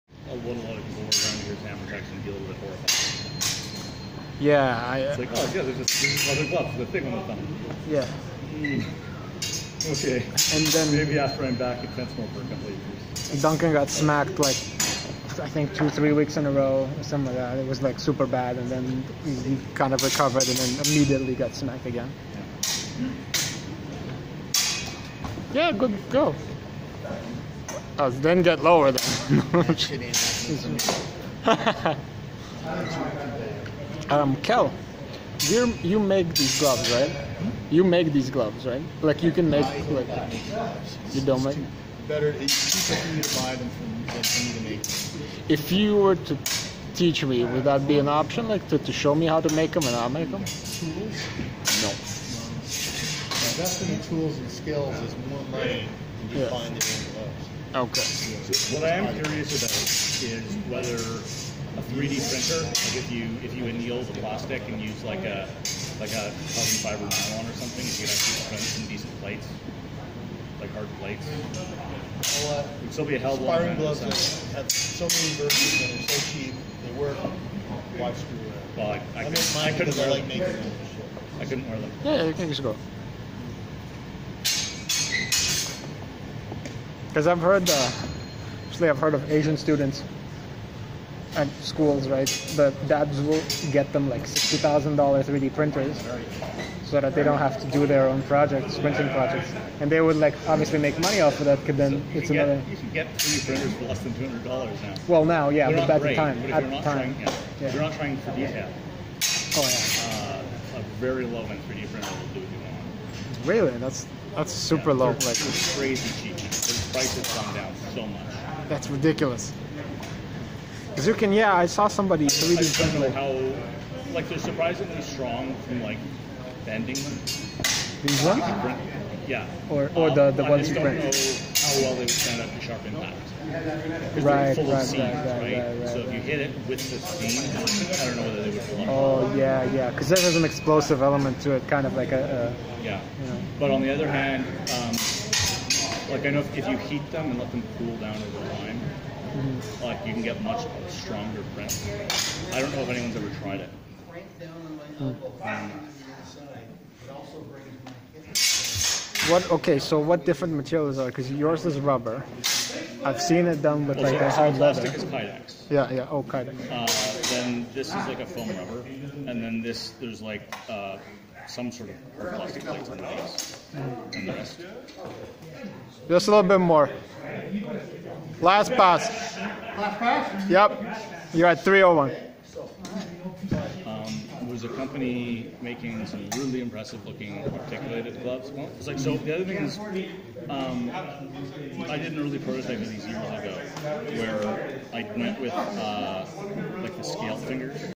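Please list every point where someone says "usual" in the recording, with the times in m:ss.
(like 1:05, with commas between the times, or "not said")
not said.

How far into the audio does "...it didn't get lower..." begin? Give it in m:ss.
0:28.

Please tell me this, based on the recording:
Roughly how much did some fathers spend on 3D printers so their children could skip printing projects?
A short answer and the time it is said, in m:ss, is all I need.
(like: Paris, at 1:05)
$60,000, at 1:34.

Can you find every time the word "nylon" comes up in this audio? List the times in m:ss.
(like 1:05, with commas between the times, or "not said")
1:07.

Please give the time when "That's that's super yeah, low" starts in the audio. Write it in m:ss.
1:53.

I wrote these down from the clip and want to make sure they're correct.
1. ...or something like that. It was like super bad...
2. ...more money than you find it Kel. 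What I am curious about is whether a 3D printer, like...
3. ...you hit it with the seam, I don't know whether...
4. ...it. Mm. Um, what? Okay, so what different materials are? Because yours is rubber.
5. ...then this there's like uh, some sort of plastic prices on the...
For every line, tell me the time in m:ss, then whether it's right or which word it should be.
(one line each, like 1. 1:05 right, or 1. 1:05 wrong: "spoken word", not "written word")
1. 0:16 right
2. 0:55 wrong: "Okay", not "Kel"
3. 2:16 right
4. 2:33 right
5. 2:49 wrong: "plates", not "prices".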